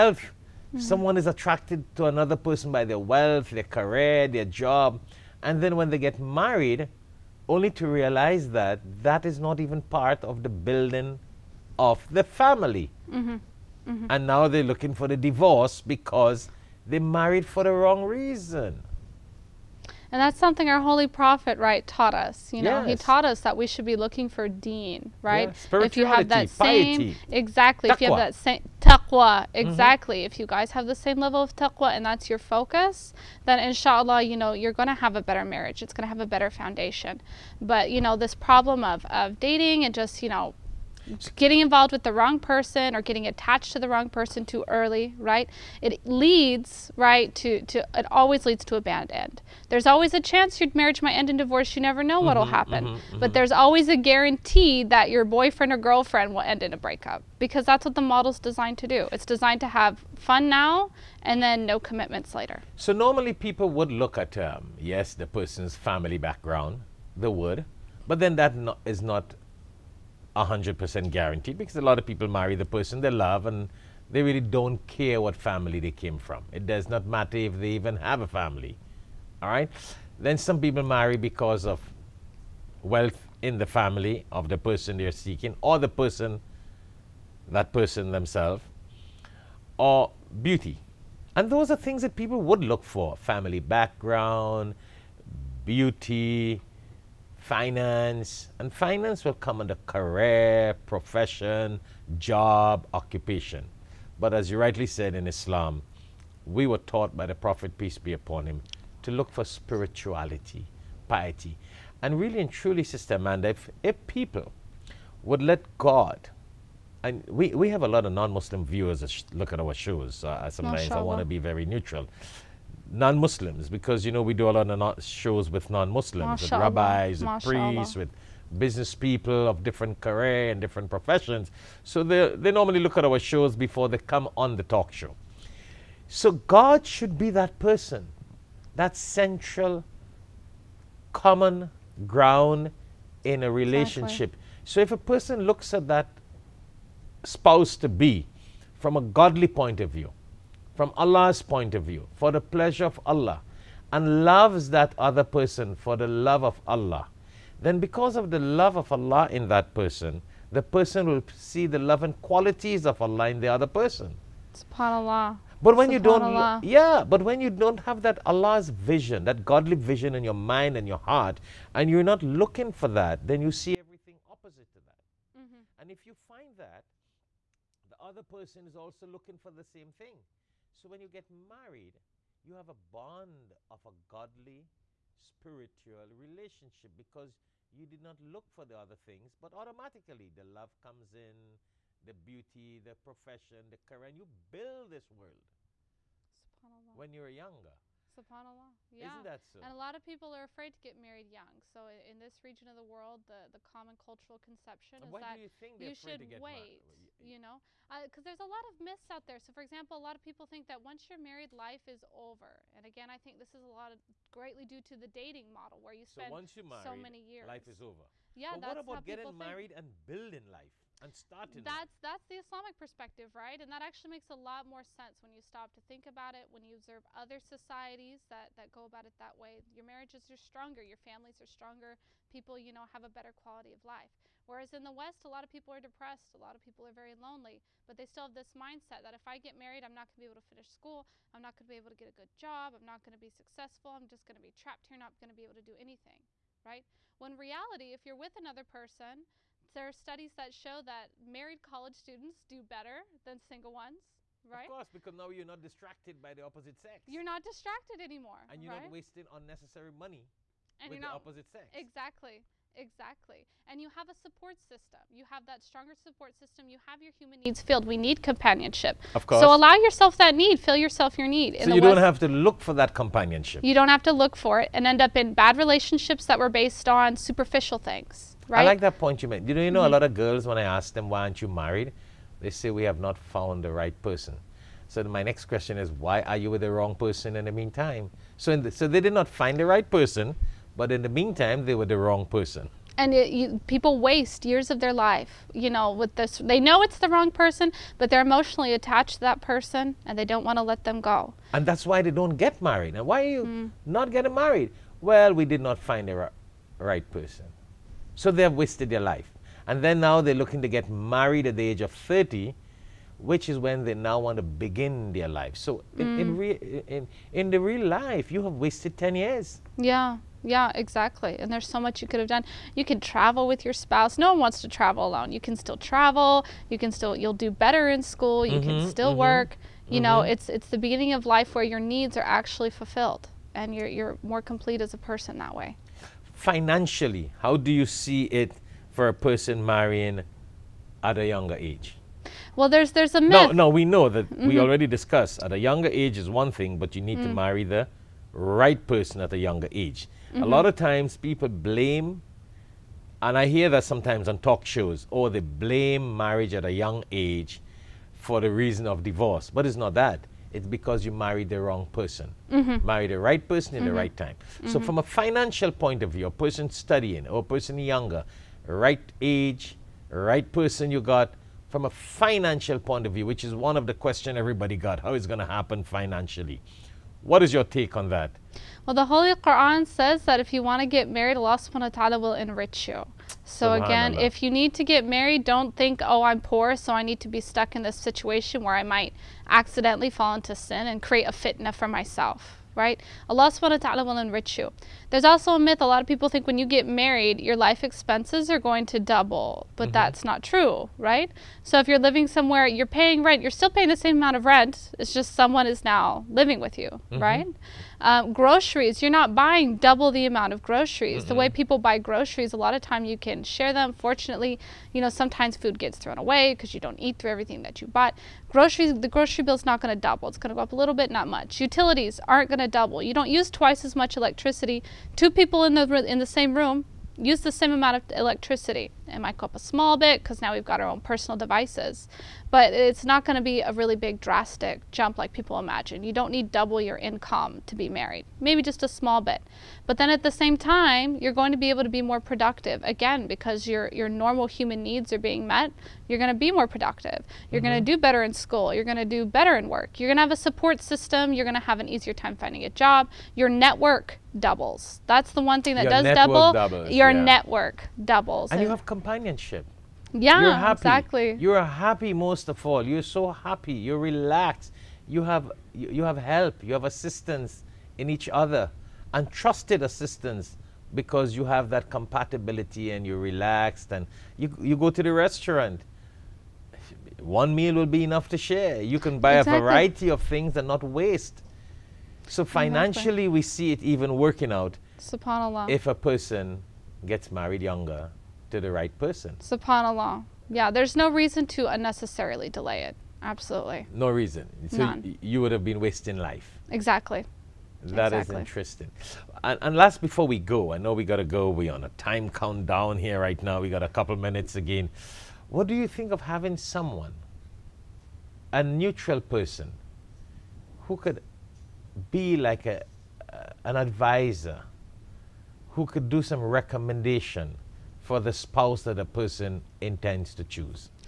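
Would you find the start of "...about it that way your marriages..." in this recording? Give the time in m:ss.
3:48.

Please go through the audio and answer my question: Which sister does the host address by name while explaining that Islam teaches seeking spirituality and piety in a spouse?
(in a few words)
Amanda.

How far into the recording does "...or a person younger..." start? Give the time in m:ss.
6:07.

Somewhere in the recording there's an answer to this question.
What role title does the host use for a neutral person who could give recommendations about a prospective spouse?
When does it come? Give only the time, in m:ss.
8:33.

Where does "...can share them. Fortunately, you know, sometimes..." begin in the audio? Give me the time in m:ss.
6:53.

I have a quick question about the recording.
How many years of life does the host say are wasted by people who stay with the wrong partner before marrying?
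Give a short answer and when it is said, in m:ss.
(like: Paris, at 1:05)
10, at 5:18.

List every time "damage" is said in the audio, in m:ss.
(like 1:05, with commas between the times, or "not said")
not said.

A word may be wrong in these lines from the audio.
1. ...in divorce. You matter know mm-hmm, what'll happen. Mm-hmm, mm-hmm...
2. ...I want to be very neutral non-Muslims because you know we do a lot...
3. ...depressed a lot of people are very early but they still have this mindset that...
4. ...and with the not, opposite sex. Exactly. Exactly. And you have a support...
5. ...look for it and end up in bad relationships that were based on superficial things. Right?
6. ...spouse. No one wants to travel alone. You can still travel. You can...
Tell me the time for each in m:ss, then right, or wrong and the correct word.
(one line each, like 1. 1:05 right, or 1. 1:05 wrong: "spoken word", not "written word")
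1. 0:51 wrong: "never", not "matter"
2. 2:00 right
3. 3:55 wrong: "lonely", not "early"
4. 4:20 right
5. 4:34 right
6. 5:23 right.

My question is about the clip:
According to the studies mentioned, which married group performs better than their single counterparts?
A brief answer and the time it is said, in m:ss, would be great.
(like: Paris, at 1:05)
college students, at 4:11.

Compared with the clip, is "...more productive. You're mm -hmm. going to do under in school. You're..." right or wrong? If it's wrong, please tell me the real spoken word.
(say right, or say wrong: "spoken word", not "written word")
wrong: "better", not "under".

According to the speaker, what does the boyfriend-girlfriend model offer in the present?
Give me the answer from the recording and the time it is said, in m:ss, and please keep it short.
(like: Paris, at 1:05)
fun, at 1:00.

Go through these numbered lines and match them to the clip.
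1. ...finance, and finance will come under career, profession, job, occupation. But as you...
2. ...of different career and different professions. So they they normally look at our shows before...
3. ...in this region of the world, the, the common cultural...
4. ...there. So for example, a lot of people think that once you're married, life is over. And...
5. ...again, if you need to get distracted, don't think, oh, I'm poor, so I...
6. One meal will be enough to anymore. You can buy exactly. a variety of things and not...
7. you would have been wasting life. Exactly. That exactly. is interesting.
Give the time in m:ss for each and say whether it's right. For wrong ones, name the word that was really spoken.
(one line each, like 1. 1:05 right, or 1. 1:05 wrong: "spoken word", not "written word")
1. 1:37 right
2. 2:09 right
3. 3:21 right
4. 3:29 right
5. 6:23 wrong: "married", not "distracted"
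6. 7:57 wrong: "share", not "anymore"
7. 8:15 right.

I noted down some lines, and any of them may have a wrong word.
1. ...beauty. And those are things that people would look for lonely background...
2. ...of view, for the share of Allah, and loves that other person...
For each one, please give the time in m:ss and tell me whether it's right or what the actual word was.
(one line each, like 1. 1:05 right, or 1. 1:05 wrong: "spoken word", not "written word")
1. 1:30 wrong: "family", not "lonely"
2. 2:31 wrong: "pleasure", not "share".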